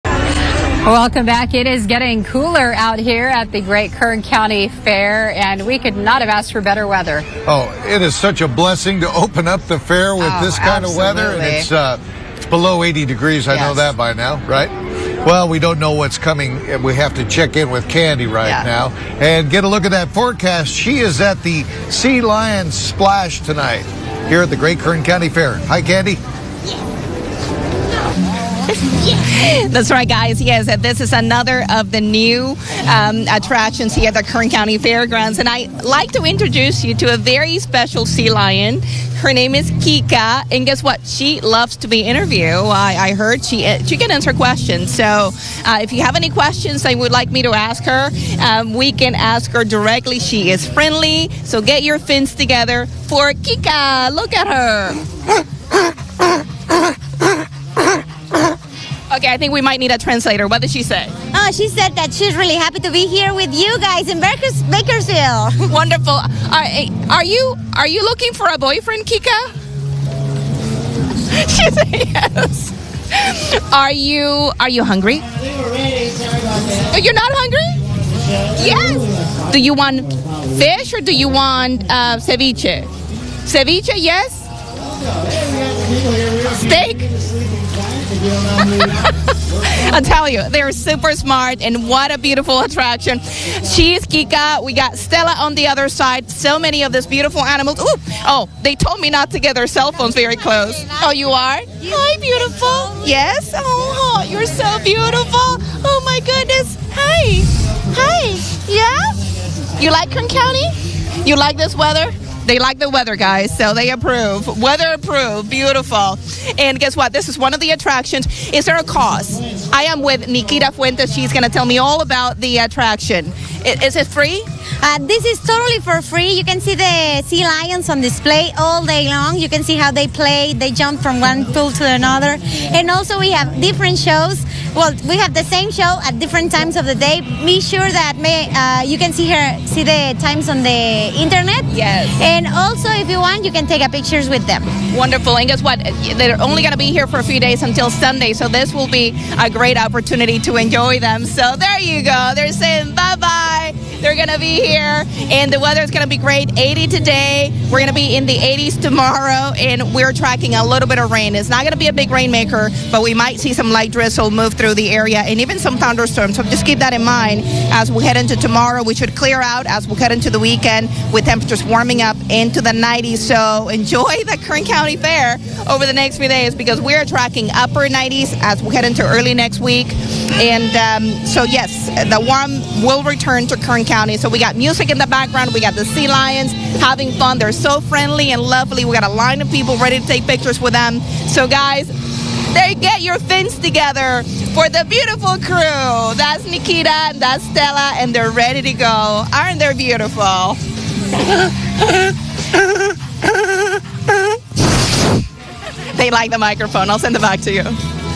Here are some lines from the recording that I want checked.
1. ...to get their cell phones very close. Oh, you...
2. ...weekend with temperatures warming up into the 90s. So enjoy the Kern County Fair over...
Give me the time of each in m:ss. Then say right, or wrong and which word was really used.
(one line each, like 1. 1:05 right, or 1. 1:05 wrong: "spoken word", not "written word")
1. 1:39 right
2. 2:50 right.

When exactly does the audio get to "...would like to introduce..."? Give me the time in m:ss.
0:35.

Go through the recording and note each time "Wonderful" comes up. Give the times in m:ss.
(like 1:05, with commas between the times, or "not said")
1:05, 2:24.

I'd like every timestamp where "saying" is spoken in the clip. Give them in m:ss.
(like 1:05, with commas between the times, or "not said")
2:32.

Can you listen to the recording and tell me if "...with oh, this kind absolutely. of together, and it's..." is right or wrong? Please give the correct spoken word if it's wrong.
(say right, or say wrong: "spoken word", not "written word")
wrong: "weather", not "together".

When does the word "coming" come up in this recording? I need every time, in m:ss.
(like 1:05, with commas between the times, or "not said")
0:16.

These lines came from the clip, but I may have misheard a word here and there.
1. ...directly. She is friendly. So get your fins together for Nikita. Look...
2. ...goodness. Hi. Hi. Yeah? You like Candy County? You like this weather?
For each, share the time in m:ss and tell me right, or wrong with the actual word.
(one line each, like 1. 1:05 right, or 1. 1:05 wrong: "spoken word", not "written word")
1. 0:49 wrong: "Kika", not "Nikita"
2. 1:46 wrong: "Kern", not "Candy".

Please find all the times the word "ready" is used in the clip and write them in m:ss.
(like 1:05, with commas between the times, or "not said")
3:09, 3:18.